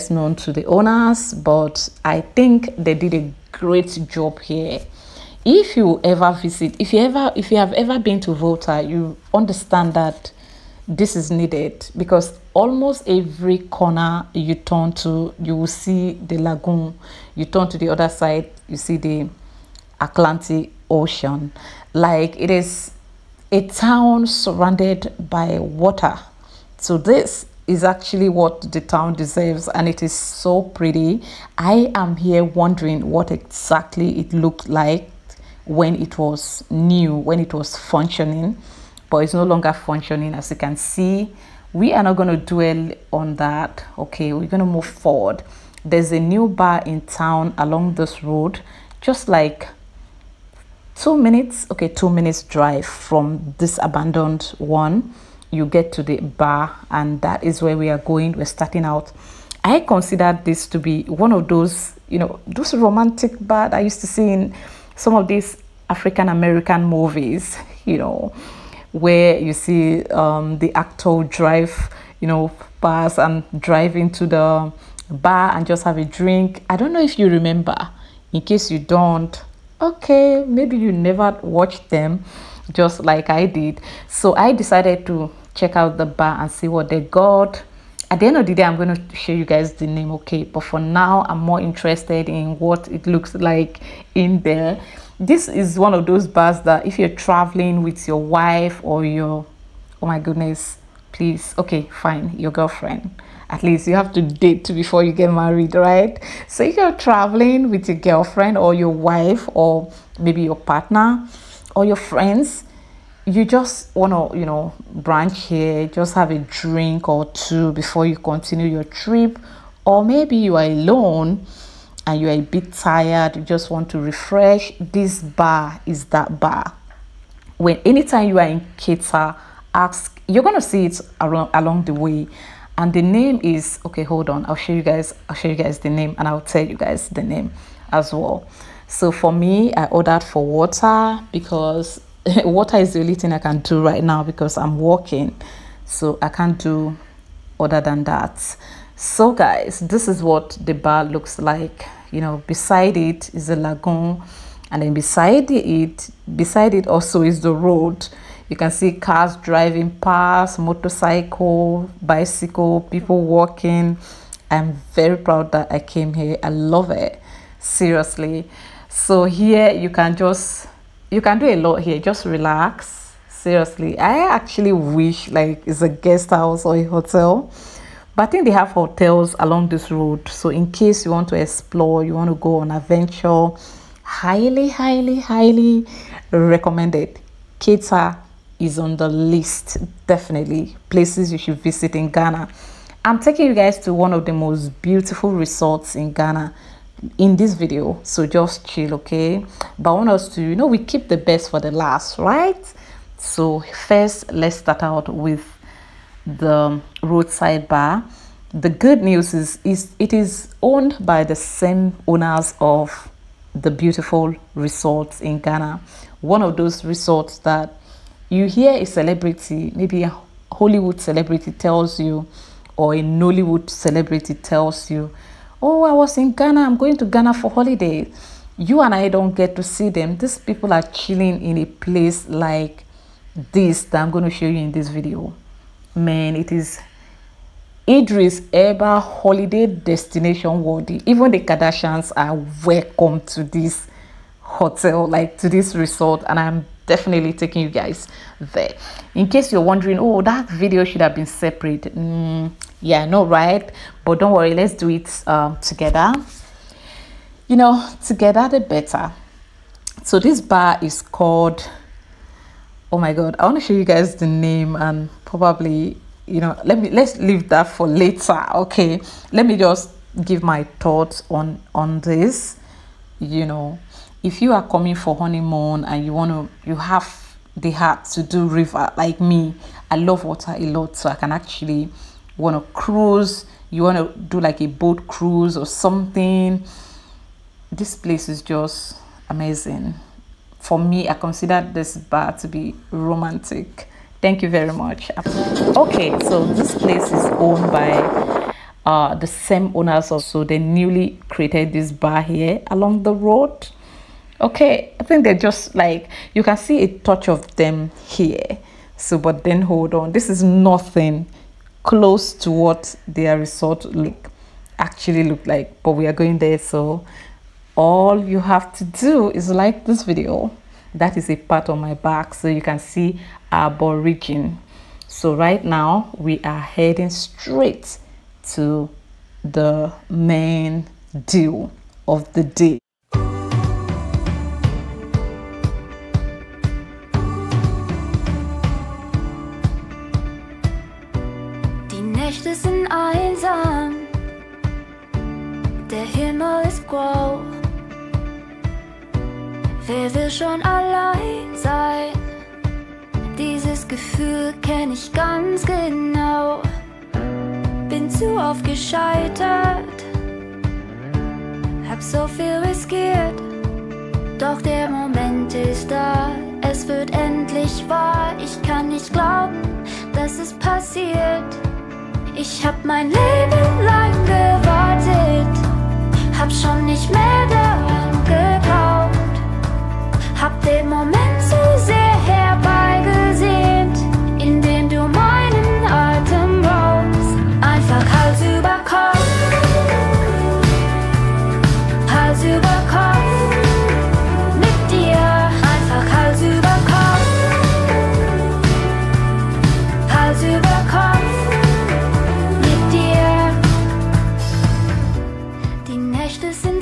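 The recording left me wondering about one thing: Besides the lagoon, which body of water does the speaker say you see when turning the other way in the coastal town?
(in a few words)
Atlantic Ocean.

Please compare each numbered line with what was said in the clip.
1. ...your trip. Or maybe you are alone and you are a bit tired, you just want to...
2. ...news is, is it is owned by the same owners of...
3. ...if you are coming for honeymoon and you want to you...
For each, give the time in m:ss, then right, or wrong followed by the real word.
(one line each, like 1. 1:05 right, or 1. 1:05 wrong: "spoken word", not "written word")
1. 1:58 right
2. 3:29 right
3. 4:34 right.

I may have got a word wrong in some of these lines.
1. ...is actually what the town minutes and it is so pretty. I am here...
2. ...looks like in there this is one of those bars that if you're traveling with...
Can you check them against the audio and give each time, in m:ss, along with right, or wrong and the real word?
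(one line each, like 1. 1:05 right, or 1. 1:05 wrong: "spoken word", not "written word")
1. 0:27 wrong: "deserves", not "minutes"
2. 1:33 right.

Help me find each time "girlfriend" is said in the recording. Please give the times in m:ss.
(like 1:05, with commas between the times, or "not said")
1:42, 1:47.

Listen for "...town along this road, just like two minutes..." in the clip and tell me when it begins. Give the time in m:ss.
0:47.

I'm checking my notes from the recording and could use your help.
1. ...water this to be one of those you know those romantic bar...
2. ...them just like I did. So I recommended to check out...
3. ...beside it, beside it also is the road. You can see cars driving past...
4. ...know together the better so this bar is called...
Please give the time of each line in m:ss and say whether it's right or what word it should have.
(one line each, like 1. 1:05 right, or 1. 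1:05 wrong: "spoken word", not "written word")
1. 0:59 wrong: "consider", not "water"
2. 1:21 wrong: "decided", not "recommended"
3. 2:34 right
4. 4:17 right.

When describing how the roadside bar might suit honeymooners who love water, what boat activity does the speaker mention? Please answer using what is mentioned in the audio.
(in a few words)
Boat cruise.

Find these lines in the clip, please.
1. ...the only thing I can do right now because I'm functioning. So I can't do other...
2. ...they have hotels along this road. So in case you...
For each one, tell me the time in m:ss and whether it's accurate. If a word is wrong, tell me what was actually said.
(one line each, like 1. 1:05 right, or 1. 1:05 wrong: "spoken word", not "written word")
1. 2:22 wrong: "walking", not "functioning"
2. 2:58 right.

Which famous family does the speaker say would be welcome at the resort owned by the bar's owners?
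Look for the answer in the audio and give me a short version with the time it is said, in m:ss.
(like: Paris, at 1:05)
The Kardashians, at 4:01.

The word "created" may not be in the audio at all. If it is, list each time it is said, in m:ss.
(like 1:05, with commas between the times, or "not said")
5:01.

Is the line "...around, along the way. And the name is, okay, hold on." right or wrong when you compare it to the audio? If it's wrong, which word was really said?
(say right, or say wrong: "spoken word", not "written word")
right.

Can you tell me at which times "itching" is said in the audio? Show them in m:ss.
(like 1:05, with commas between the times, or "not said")
not said.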